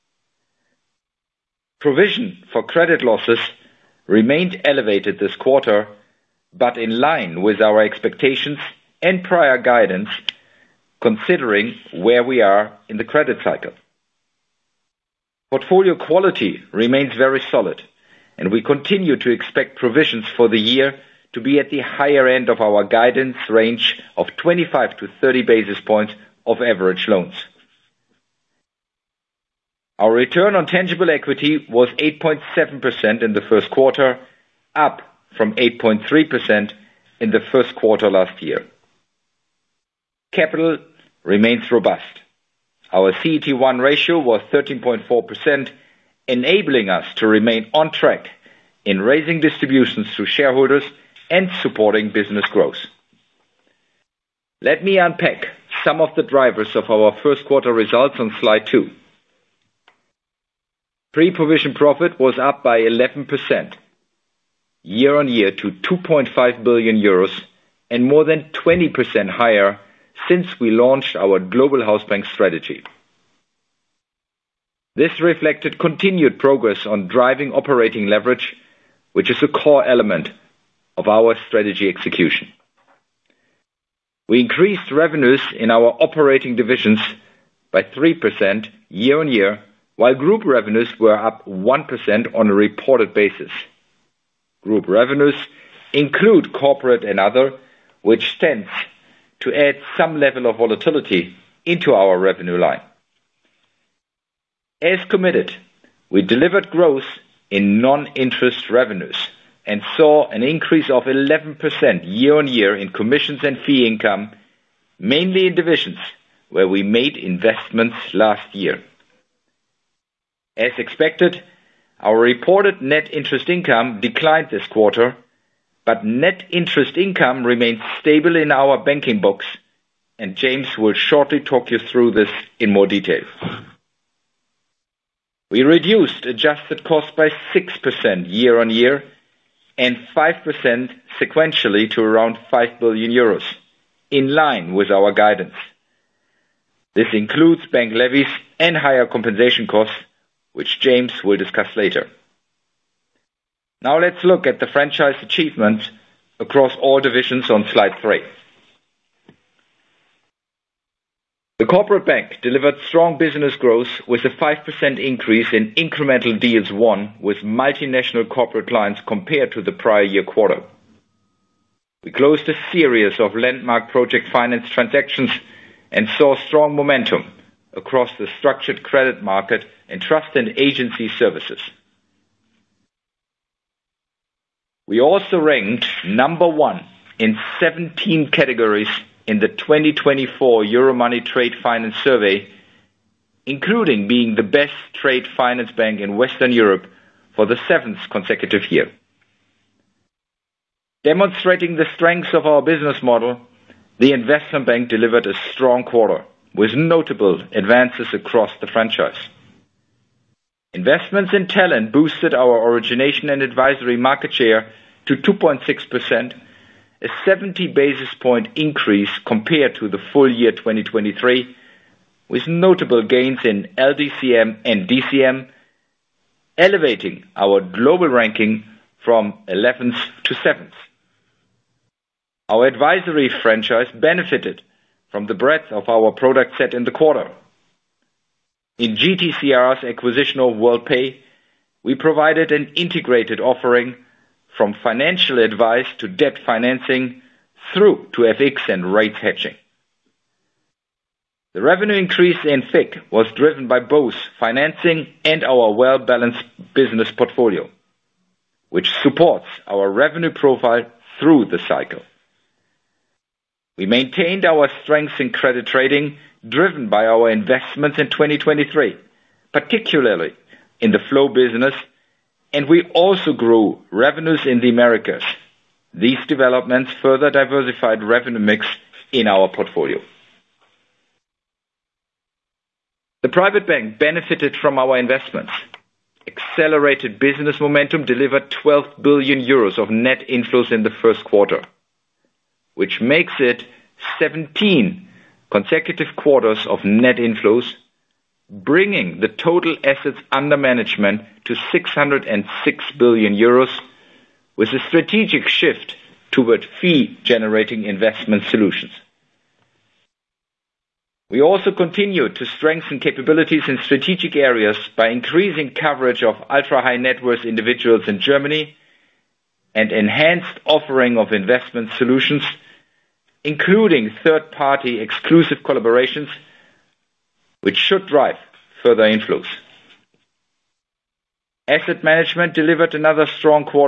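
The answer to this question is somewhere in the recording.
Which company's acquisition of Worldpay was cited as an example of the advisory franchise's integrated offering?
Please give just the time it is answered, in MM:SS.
03:58.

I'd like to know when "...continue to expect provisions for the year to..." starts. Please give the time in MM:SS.
00:18.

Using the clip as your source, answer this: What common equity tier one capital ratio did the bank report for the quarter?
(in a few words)
13.4%.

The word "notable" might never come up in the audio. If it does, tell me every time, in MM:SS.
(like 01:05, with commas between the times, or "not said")
03:26, 03:42.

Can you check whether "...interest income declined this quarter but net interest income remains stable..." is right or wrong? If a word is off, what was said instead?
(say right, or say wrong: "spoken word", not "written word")
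right.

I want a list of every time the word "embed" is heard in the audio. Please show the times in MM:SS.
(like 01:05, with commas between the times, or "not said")
not said.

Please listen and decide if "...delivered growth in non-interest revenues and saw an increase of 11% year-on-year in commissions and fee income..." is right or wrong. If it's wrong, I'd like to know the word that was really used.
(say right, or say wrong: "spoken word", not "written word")
right.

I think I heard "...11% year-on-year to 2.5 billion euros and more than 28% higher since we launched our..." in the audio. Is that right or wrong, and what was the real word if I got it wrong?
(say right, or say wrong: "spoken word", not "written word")
wrong: "20", not "28".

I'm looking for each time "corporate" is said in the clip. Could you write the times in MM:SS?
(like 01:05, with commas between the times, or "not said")
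01:36, 02:41, 02:48.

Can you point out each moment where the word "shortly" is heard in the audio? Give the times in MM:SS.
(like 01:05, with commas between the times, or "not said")
02:10.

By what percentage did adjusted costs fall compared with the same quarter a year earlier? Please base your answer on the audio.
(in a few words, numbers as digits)
6%.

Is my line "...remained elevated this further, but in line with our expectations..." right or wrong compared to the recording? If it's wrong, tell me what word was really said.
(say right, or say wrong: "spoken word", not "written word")
wrong: "quarter", not "further".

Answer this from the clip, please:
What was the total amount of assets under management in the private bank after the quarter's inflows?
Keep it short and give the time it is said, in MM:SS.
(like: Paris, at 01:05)
606 billion euros, at 05:01.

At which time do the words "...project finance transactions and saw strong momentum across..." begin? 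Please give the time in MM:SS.
02:53.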